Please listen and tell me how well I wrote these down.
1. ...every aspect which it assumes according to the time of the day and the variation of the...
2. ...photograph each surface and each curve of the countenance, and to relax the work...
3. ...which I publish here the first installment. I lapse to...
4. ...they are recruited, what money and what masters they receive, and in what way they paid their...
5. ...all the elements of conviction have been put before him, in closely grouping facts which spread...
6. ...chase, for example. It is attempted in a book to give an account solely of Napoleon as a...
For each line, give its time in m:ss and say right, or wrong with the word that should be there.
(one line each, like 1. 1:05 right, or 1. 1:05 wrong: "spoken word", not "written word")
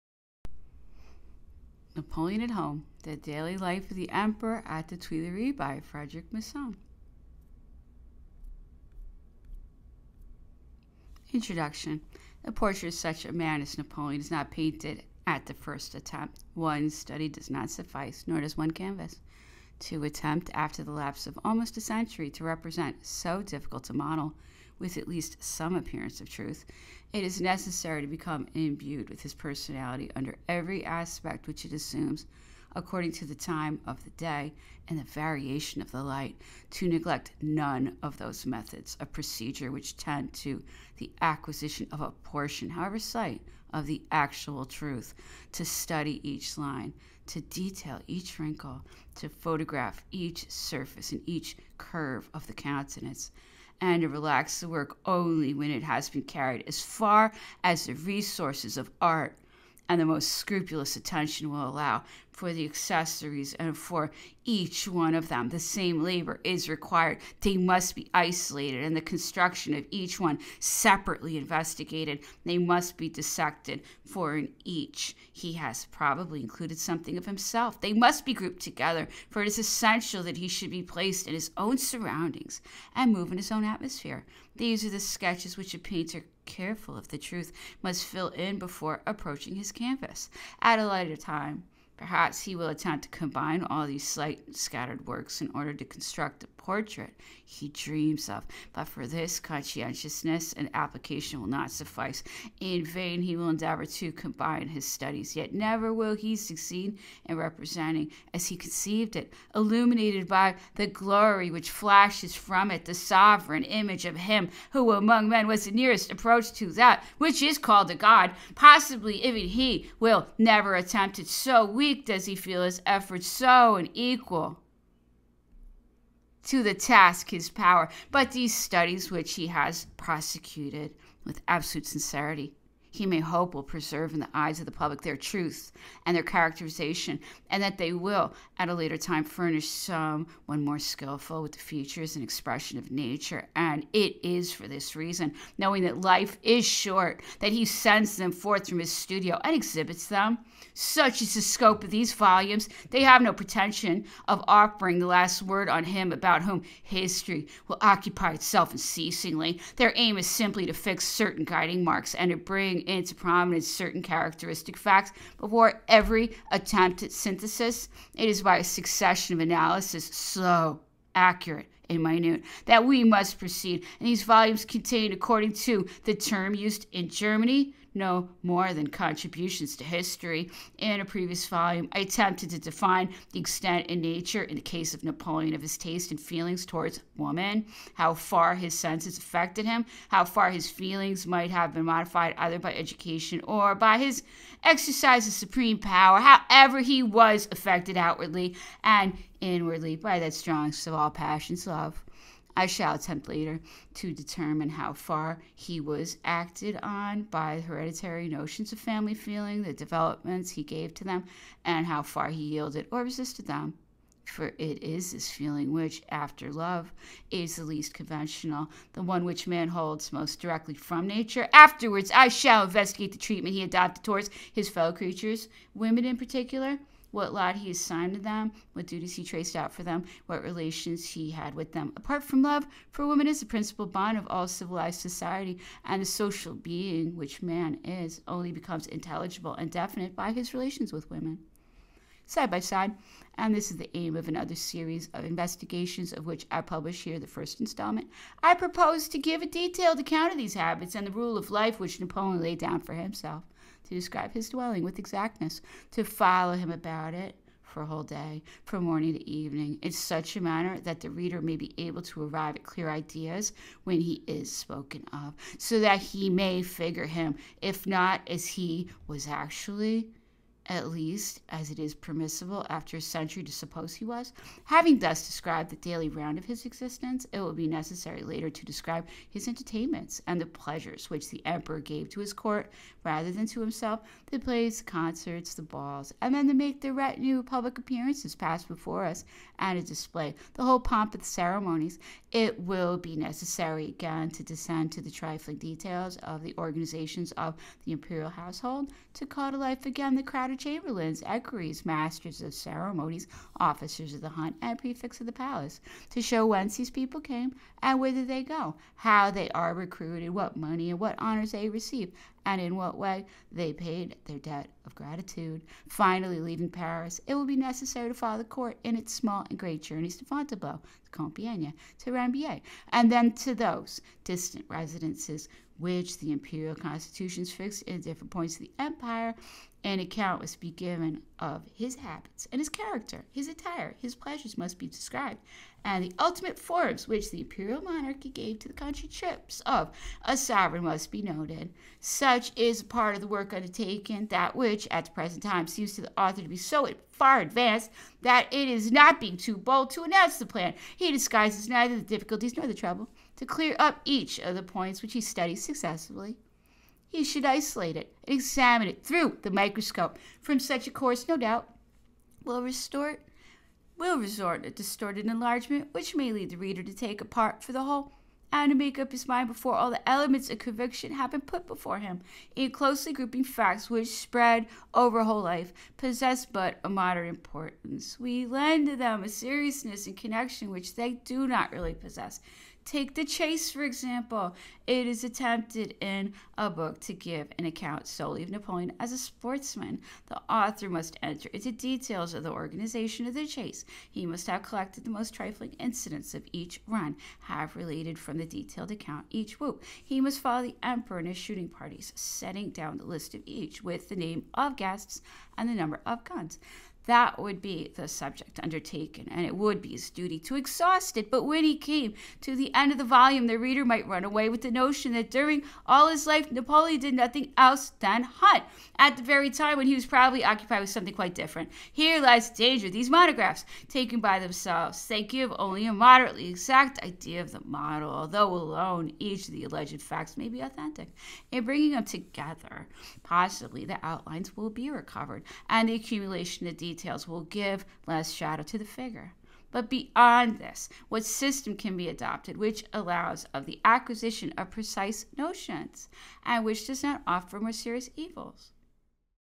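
1. 0:30 right
2. 0:49 right
3. 4:06 wrong: "propose", not "lapse"
4. 5:09 wrong: "honors", not "masters"
5. 6:09 right
6. 6:23 right.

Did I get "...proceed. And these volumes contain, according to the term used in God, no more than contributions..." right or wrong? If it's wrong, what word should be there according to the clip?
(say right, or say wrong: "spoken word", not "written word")
wrong: "Germany", not "God".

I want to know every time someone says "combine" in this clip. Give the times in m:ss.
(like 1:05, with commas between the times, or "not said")
1:33, 1:44.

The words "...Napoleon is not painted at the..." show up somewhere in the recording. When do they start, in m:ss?
0:13.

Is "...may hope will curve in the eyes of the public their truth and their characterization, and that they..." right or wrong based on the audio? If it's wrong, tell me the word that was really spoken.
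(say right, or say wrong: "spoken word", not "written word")
wrong: "preserve", not "curve".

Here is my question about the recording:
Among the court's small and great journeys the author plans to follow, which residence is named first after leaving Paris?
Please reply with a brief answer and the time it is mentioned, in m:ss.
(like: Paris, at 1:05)
Fontainebleau, at 5:20.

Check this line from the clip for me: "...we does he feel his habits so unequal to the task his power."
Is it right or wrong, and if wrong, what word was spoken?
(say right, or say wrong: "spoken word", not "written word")
wrong: "efforts", not "habits".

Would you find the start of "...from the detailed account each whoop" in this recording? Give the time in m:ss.
6:38.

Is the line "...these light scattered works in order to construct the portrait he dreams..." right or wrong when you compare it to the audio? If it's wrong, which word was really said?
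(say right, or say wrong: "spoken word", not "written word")
wrong: "slight", not "light".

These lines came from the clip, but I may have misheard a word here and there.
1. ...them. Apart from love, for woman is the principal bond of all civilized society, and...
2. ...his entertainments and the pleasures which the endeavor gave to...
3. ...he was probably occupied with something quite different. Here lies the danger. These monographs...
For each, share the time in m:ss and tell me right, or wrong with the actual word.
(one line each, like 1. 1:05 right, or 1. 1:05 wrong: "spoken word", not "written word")
1. 3:51 right
2. 4:39 wrong: "emperor", not "endeavor"
3. 6:59 right.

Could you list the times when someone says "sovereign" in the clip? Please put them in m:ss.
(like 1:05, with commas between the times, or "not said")
1:52, 5:40.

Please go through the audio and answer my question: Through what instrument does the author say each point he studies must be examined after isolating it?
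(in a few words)
the microscope.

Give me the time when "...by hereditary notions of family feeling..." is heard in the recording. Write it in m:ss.
3:27.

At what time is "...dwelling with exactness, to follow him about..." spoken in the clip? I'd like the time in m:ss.
4:14.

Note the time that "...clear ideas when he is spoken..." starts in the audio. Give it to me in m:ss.
4:22.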